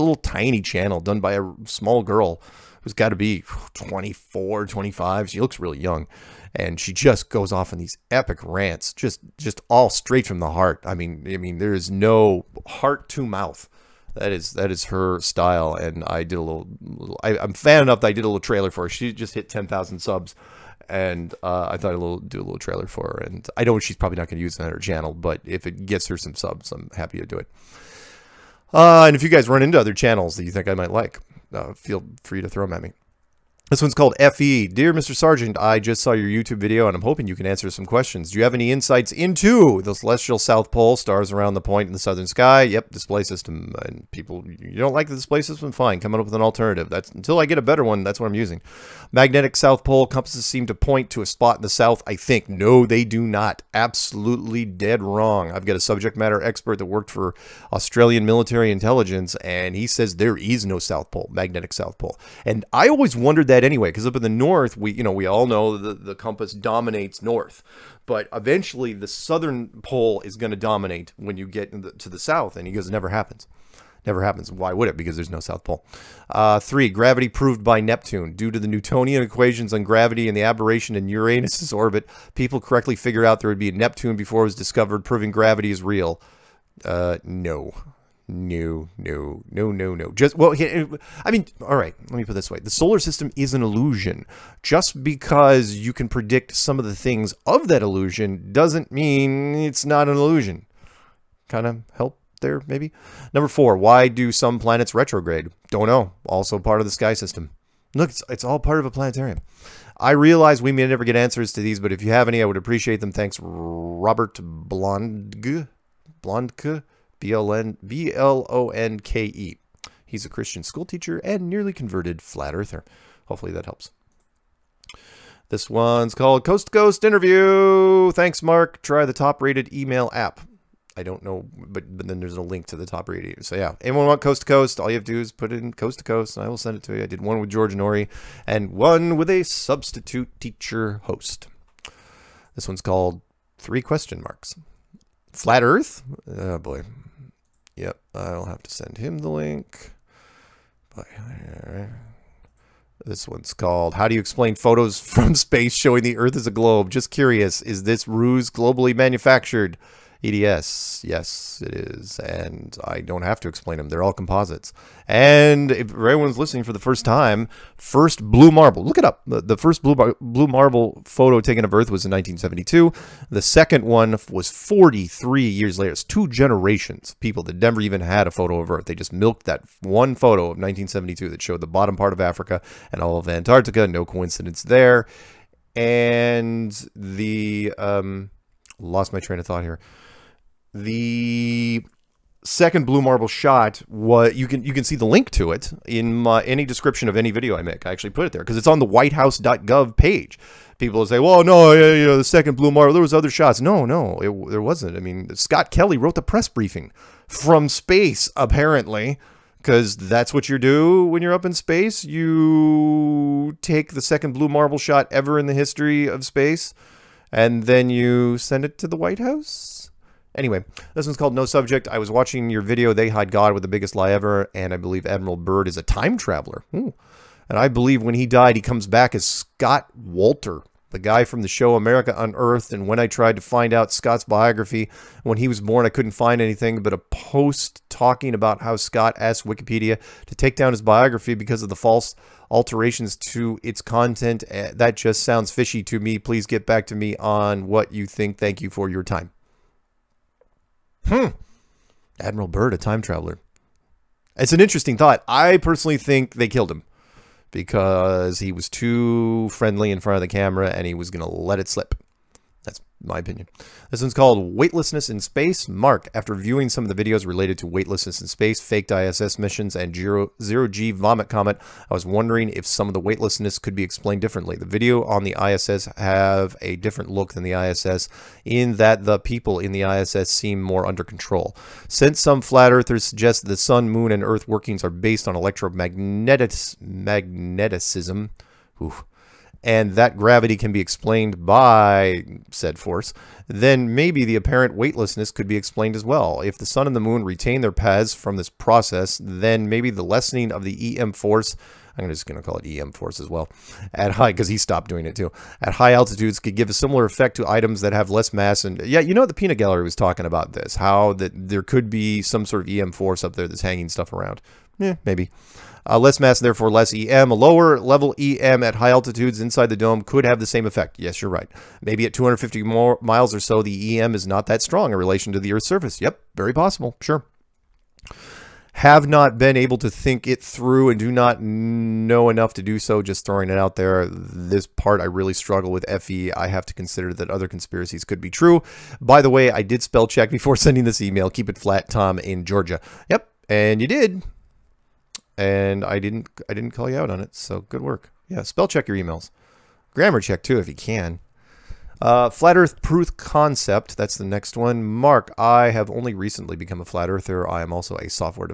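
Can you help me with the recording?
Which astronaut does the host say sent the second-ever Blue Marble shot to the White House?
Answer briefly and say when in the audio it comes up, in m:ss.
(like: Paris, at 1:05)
Scott Kelly, at 3:25.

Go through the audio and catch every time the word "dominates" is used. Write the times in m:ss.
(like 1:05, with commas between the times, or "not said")
1:06, 1:10.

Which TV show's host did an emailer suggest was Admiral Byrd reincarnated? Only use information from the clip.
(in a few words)
America Unearthed.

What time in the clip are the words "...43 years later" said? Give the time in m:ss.
2:54.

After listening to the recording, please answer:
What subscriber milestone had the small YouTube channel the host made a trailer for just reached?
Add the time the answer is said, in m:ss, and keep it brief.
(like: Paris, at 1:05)
10,000, at 0:19.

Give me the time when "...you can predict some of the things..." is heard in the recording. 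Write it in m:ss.
1:35.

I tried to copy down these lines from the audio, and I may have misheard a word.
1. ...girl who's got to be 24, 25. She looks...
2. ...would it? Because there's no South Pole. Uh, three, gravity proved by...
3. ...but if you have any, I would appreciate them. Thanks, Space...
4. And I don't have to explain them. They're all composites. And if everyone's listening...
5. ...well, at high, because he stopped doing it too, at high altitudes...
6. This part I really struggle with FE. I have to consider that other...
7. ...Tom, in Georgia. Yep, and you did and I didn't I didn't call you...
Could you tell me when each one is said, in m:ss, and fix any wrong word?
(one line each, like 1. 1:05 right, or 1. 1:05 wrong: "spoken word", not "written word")
1. 0:02 right
2. 1:14 right
3. 1:51 wrong: "Robert", not "Space"
4. 2:42 right
5. 5:03 right
6. 5:34 right
7. 5:41 right.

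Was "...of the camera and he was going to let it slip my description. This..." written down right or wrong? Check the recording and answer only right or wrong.
wrong.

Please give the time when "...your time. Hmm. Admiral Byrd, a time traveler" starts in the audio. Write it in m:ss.
4:08.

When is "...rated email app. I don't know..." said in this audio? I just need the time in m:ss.
2:09.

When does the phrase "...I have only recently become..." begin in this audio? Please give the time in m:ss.
5:55.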